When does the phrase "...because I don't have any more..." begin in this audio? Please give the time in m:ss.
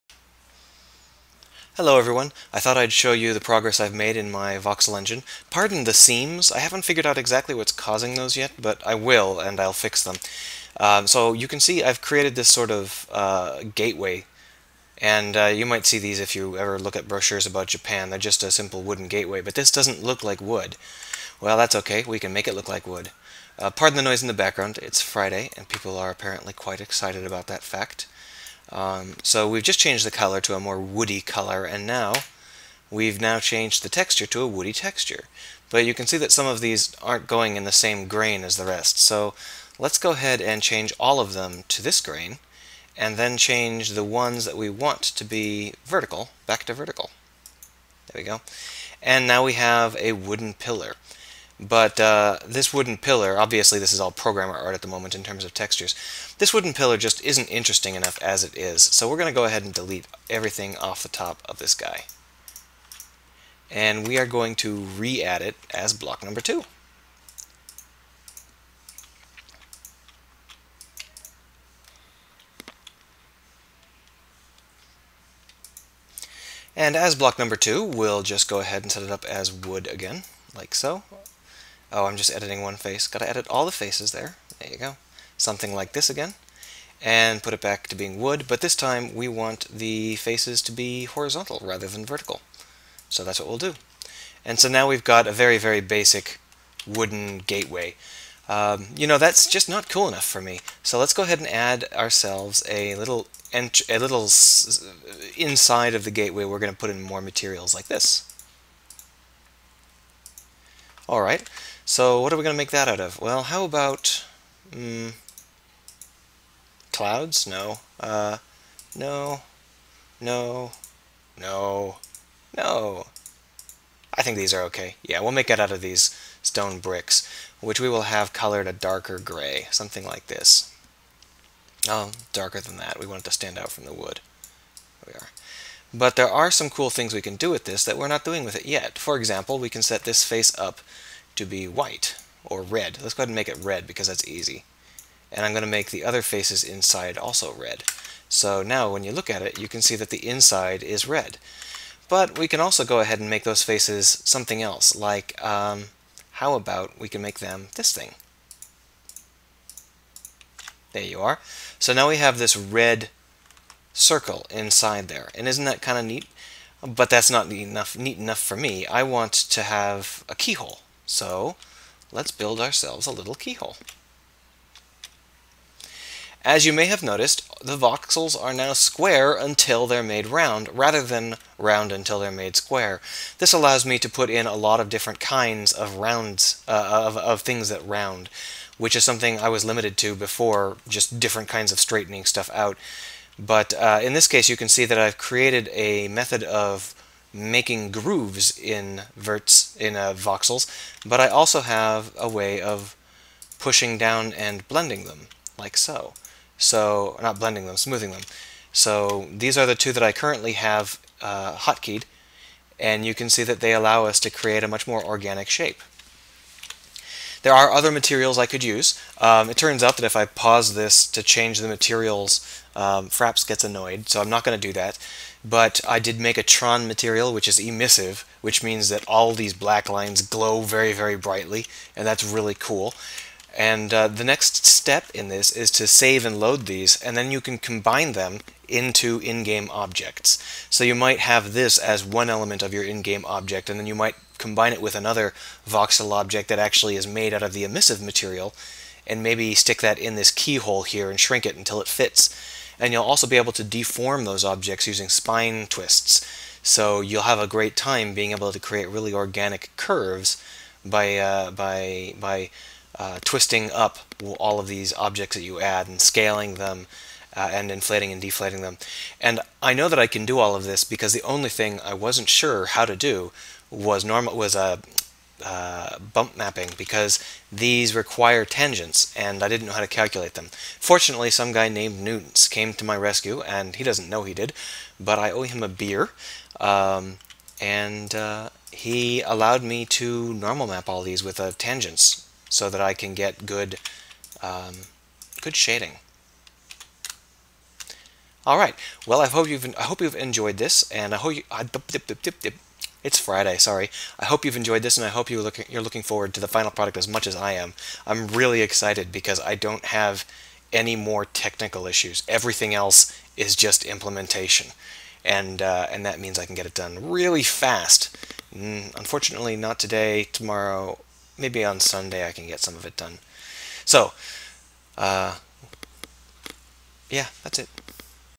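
5:09.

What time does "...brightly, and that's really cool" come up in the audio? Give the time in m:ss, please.
3:51.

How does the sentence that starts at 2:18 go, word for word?
For example, we can set this face up to be white or red.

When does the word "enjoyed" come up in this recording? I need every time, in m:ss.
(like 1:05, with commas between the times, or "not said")
5:00, 5:04.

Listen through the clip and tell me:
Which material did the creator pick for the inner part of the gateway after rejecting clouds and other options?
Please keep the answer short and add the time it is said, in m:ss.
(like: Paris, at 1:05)
stone bricks, at 2:06.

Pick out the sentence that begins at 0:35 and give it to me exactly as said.
But you can see that some of these aren't going in the same grain as the rest.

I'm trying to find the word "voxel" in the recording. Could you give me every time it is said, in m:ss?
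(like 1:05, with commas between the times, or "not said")
0:04, 2:57, 3:20, 4:05.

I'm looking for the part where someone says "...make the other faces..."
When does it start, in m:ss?
2:25.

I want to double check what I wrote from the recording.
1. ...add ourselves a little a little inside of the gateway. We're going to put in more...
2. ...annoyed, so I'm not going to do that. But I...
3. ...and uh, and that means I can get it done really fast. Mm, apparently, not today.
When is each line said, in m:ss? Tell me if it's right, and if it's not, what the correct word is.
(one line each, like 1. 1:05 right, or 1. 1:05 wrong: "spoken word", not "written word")
1. 1:41 right
2. 3:43 right
3. 5:15 wrong: "unfortunately", not "apparently".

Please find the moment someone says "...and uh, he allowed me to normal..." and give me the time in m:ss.
4:47.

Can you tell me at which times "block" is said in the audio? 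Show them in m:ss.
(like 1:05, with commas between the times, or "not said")
1:05, 1:17.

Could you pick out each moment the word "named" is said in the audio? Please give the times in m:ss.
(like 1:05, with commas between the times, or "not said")
4:41.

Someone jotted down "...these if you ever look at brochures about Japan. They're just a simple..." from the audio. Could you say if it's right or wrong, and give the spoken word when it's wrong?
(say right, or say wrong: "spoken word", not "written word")
right.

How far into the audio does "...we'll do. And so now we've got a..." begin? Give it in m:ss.
1:33.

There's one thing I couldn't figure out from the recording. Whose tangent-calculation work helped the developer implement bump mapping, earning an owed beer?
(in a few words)
Newtons.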